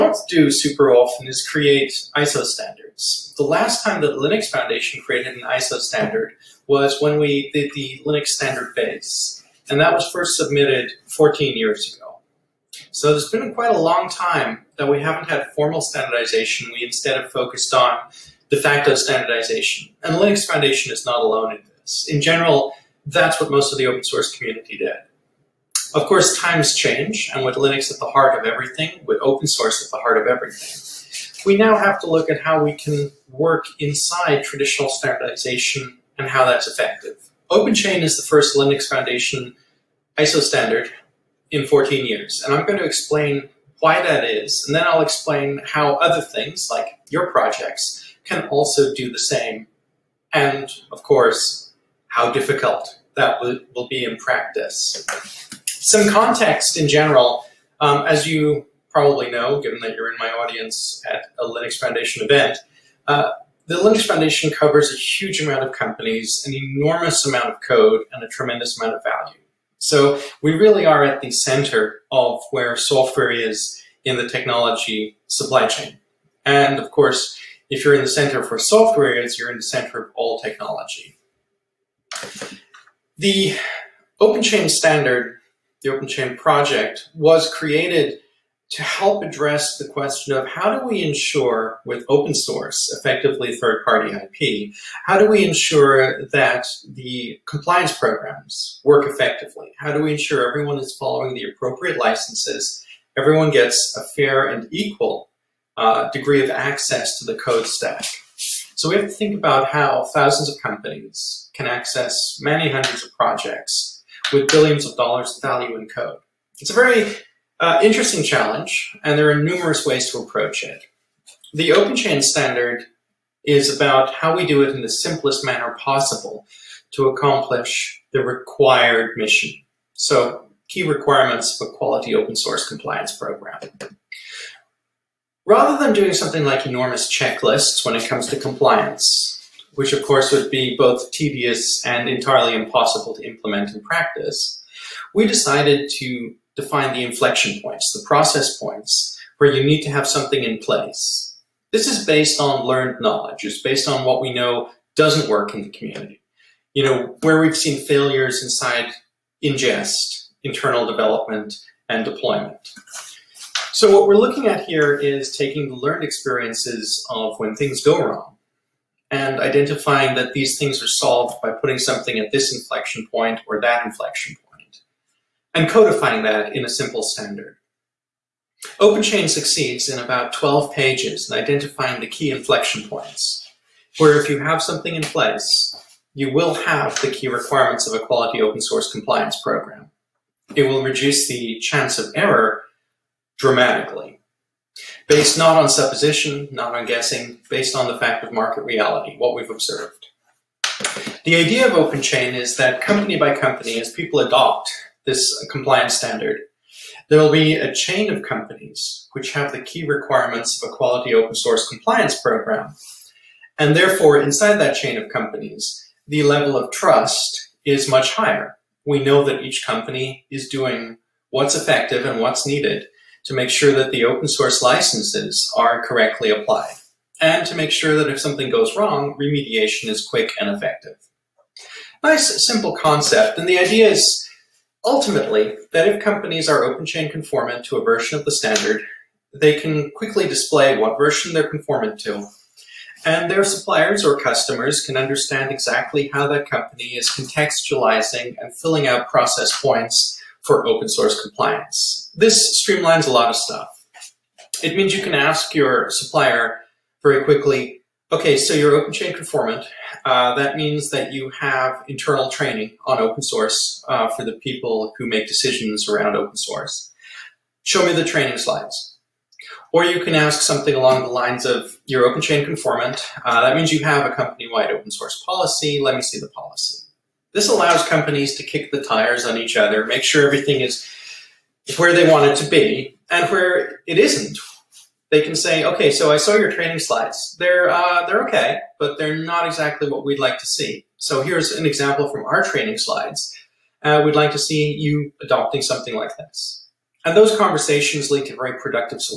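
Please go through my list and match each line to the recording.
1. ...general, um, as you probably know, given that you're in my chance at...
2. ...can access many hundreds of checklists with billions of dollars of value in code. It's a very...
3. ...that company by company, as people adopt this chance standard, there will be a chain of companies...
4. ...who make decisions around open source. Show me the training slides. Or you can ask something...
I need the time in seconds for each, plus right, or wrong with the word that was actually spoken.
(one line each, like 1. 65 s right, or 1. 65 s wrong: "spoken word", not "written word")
1. 56 s wrong: "audience", not "chance"
2. 111 s wrong: "projects", not "checklists"
3. 202 s wrong: "compliance", not "chance"
4. 264 s right.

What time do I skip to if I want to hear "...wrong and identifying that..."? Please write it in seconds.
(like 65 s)
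168 s.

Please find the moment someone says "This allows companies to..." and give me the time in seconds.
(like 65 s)
277 s.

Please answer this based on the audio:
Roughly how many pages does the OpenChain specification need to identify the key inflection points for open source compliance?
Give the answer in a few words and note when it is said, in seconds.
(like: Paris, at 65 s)
12, at 180 s.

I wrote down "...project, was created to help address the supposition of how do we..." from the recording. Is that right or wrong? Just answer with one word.
wrong.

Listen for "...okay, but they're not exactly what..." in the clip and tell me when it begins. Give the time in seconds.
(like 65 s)
288 s.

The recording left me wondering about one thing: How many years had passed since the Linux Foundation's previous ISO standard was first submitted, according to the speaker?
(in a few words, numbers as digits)
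14.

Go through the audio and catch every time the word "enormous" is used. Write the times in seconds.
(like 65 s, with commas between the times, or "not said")
66 s, 136 s.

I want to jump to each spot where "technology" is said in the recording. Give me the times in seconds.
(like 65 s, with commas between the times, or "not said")
74 s, 80 s.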